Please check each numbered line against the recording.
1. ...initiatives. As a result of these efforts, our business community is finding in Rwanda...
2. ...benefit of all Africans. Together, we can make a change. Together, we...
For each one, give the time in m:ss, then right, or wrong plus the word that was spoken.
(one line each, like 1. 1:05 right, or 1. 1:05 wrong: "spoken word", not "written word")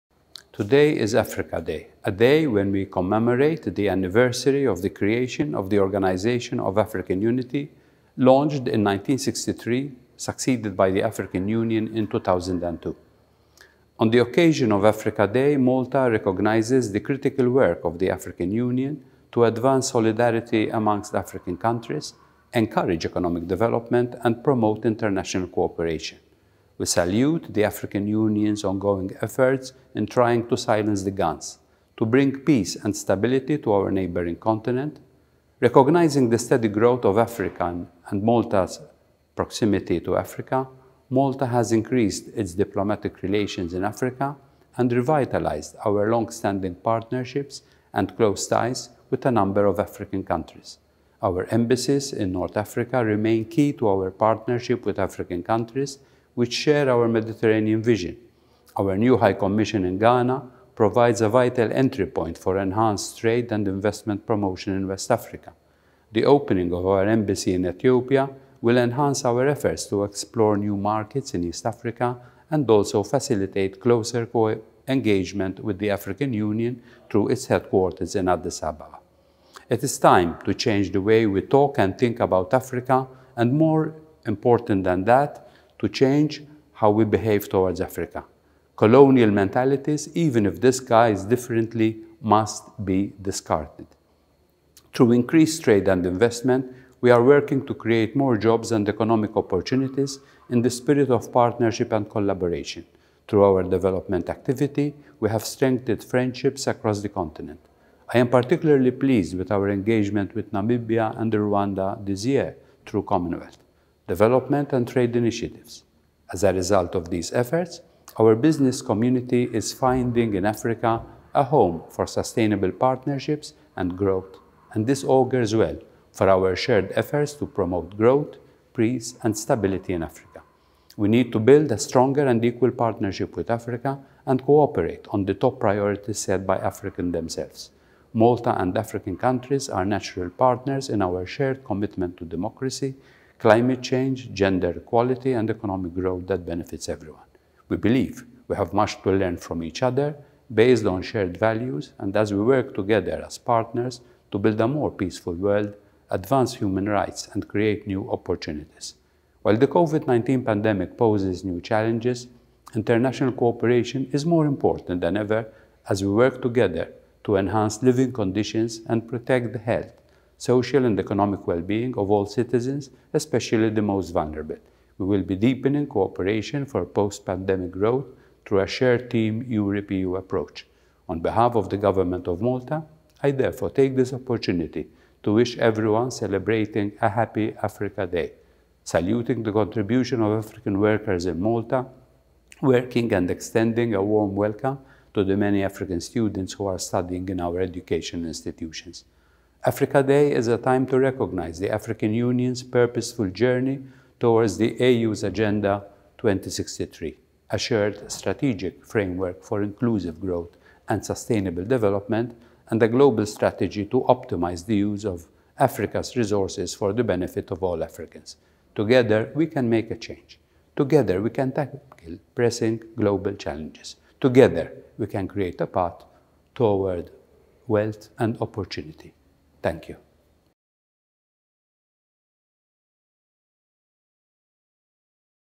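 1. 1:55 wrong: "Africa", not "Rwanda"
2. 3:37 right.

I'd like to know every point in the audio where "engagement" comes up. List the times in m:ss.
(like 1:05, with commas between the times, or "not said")
1:14, 1:49.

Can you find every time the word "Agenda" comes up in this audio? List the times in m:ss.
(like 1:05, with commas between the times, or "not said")
3:25.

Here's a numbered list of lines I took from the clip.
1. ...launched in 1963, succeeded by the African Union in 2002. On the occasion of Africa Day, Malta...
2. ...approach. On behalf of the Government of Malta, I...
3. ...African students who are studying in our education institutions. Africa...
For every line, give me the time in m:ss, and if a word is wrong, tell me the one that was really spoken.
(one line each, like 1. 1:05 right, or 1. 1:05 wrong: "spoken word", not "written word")
1. 0:08 right
2. 3:00 right
3. 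3:15 right.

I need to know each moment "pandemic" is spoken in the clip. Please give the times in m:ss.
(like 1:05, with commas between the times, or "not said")
2:40, 2:56.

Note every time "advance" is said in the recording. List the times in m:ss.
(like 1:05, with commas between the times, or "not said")
0:19, 2:36.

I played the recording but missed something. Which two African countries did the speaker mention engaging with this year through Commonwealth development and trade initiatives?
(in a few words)
Namibia and Rwanda.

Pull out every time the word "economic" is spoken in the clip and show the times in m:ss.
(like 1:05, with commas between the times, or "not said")
0:23, 1:38, 2:25, 2:50.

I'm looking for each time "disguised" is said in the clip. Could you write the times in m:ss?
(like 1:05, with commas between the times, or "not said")
1:30.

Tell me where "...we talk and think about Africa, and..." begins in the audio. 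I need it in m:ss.
1:21.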